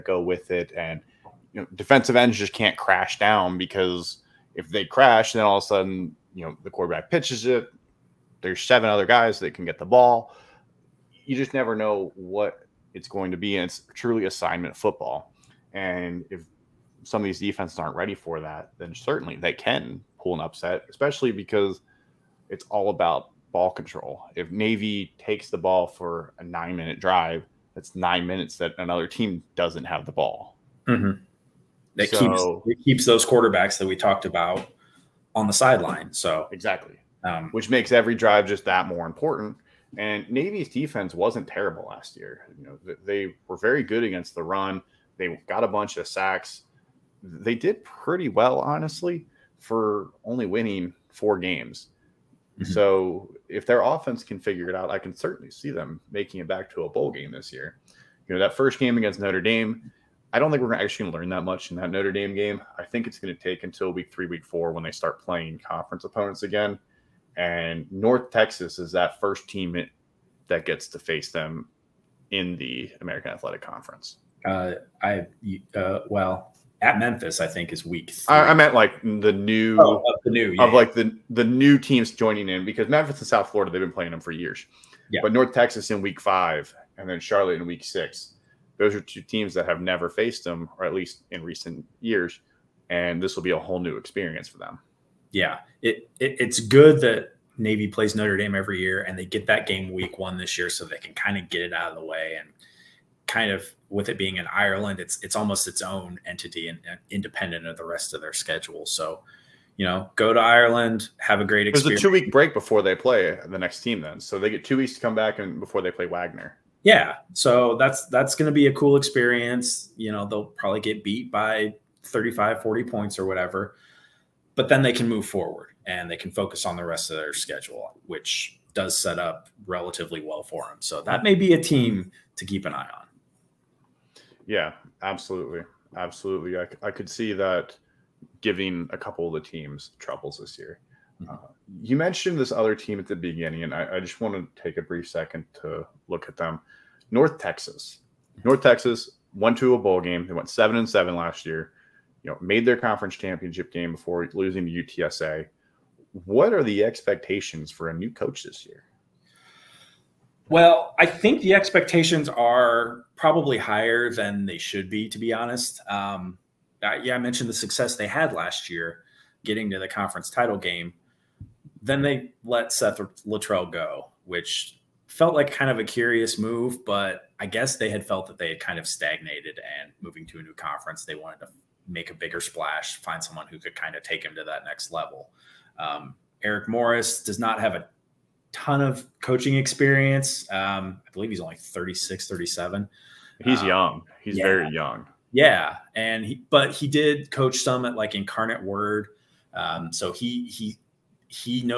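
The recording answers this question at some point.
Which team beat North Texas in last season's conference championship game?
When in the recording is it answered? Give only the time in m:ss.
2:34.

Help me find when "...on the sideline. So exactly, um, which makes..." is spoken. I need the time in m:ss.
0:35.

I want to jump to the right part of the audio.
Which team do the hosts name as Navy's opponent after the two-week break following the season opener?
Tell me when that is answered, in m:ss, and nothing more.
1:56.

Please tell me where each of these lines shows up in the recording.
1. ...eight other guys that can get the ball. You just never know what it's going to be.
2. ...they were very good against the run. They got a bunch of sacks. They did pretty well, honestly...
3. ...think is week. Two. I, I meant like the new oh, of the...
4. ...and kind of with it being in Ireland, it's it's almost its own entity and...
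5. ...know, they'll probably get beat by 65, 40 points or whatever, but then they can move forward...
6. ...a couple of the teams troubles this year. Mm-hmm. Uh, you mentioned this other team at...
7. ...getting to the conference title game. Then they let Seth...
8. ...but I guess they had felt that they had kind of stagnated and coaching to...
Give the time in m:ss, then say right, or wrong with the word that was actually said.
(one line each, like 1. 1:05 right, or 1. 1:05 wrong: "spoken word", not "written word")
1. 0:08 wrong: "seven", not "eight"
2. 0:43 right
3. 1:17 wrong: "Three", not "Two"
4. 1:42 right
5. 2:00 wrong: "35", not "65"
6. 2:18 right
7. 2:49 right
8. 2:56 wrong: "moving", not "coaching".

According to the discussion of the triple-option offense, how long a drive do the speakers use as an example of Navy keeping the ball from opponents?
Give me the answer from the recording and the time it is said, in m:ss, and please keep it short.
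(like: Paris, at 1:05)
9 minutes, at 0:26.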